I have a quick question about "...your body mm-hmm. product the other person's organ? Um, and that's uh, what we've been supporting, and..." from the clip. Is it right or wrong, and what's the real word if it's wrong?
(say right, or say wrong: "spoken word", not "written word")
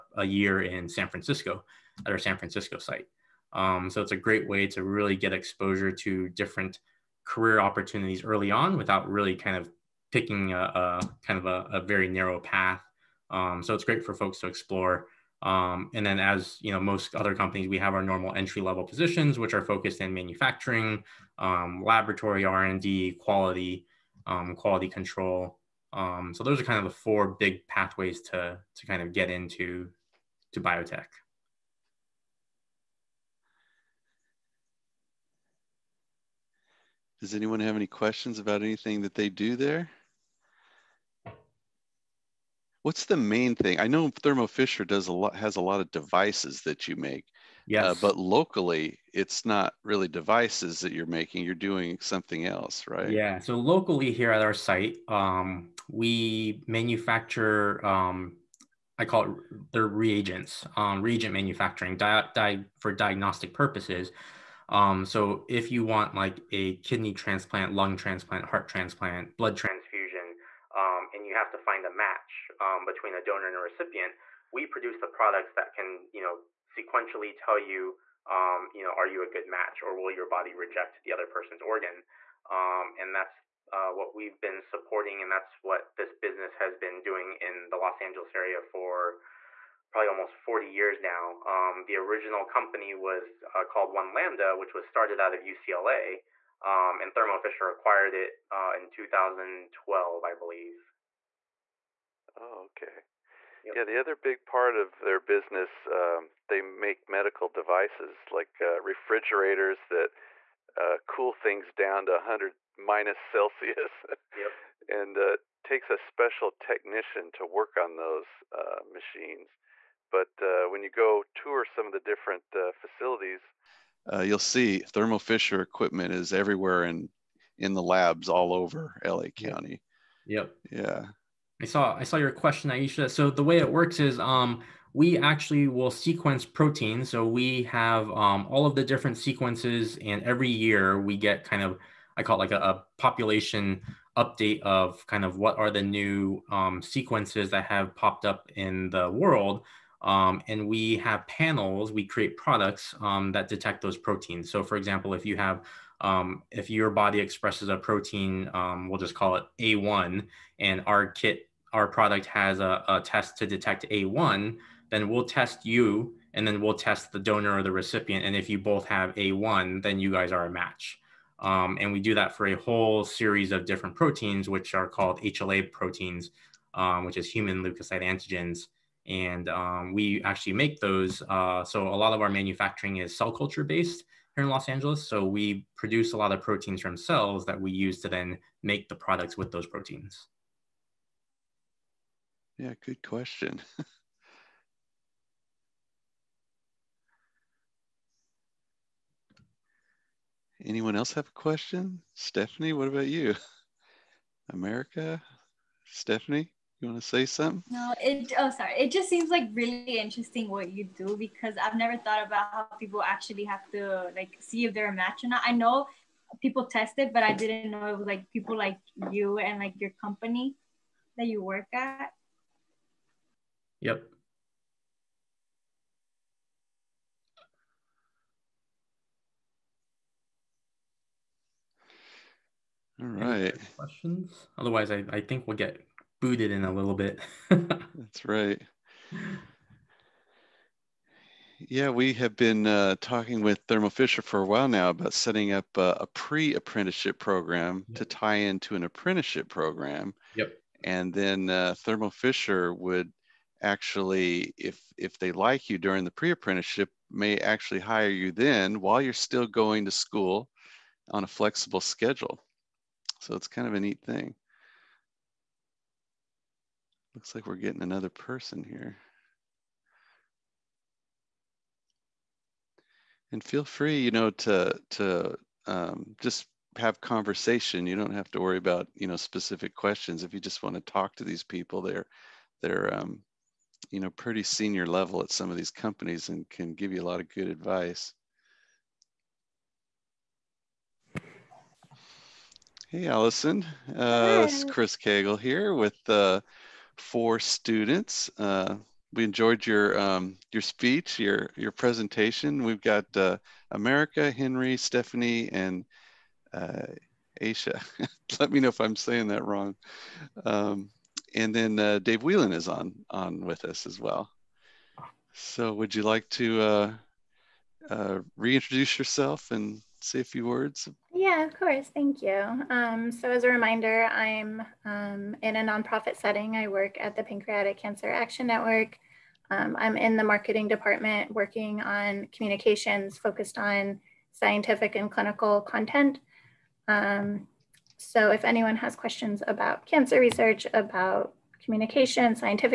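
wrong: "reject", not "product".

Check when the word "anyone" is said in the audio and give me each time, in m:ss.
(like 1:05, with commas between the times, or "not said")
0:37, 3:20, 5:38.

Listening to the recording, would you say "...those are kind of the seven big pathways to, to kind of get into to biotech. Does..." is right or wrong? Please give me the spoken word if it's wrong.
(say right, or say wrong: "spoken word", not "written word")
wrong: "four", not "seven".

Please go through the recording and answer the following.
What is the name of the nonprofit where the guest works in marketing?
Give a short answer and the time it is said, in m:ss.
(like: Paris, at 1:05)
Pancreatic Cancer Action Network, at 5:27.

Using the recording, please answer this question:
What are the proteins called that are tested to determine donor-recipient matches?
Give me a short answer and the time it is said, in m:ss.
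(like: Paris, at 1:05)
HLA proteins, at 2:55.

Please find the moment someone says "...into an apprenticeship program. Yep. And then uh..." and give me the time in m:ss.
4:08.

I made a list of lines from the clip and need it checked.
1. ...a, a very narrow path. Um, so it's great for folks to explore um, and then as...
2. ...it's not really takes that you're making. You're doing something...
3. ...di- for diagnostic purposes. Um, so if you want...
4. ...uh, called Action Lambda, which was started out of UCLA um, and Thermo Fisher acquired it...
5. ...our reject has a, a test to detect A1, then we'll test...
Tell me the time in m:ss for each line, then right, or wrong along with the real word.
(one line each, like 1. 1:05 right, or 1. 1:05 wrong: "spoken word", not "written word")
1. 0:11 right
2. 0:49 wrong: "devices", not "takes"
3. 1:02 right
4. 1:33 wrong: "One", not "Action"
5. 2:41 wrong: "product", not "reject".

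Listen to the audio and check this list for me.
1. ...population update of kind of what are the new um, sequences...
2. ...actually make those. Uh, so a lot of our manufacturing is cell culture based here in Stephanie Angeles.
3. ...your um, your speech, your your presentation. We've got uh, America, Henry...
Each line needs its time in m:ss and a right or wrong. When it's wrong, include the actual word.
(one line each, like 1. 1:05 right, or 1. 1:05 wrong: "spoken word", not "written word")
1. 2:22 right
2. 3:00 wrong: "Los", not "Stephanie"
3. 4:59 right.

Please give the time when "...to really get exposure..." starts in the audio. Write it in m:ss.
0:04.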